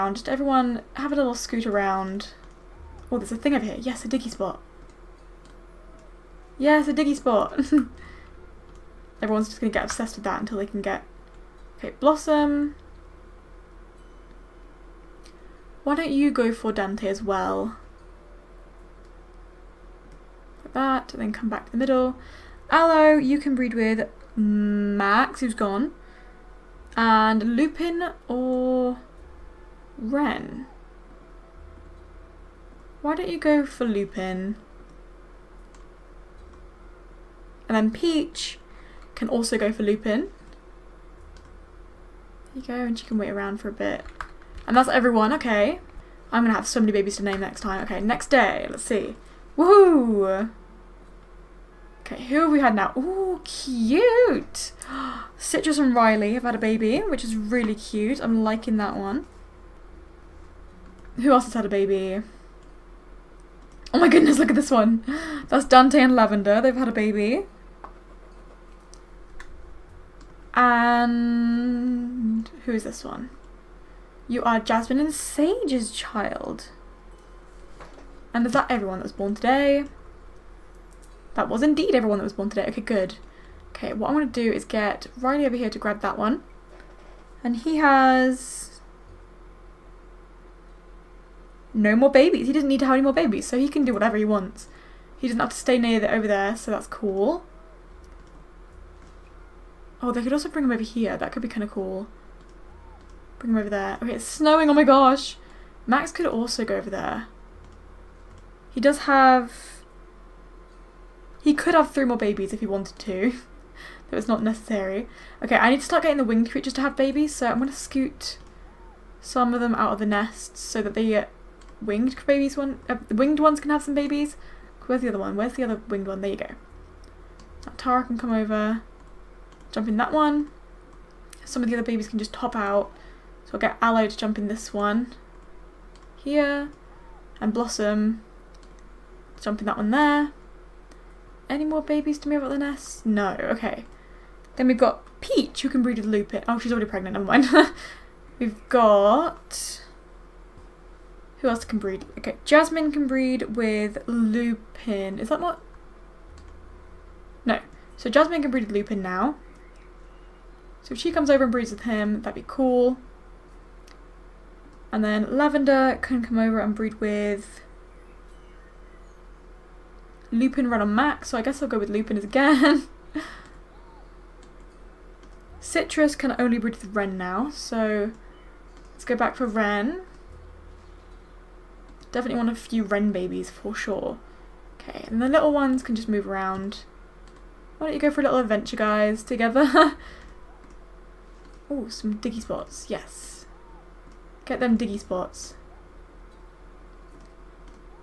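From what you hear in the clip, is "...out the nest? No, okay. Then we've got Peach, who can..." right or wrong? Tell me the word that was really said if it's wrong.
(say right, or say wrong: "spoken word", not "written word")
right.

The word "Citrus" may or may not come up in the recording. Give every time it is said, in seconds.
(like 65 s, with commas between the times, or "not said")
55 s, 175 s.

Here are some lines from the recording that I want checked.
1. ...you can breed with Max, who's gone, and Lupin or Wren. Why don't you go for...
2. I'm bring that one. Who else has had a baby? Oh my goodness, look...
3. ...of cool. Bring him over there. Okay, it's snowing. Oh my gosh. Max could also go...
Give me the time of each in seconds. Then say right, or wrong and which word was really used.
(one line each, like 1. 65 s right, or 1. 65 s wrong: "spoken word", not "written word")
1. 23 s right
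2. 58 s wrong: "liking", not "bring"
3. 101 s right.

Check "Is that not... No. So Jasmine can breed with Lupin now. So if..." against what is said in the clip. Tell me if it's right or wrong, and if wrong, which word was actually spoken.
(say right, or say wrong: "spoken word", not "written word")
right.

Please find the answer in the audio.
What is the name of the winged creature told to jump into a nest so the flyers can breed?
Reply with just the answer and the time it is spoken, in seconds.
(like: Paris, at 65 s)
Tara, at 127 s.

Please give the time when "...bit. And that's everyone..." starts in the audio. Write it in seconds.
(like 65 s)
43 s.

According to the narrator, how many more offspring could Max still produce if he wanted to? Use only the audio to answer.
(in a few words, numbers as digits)
3.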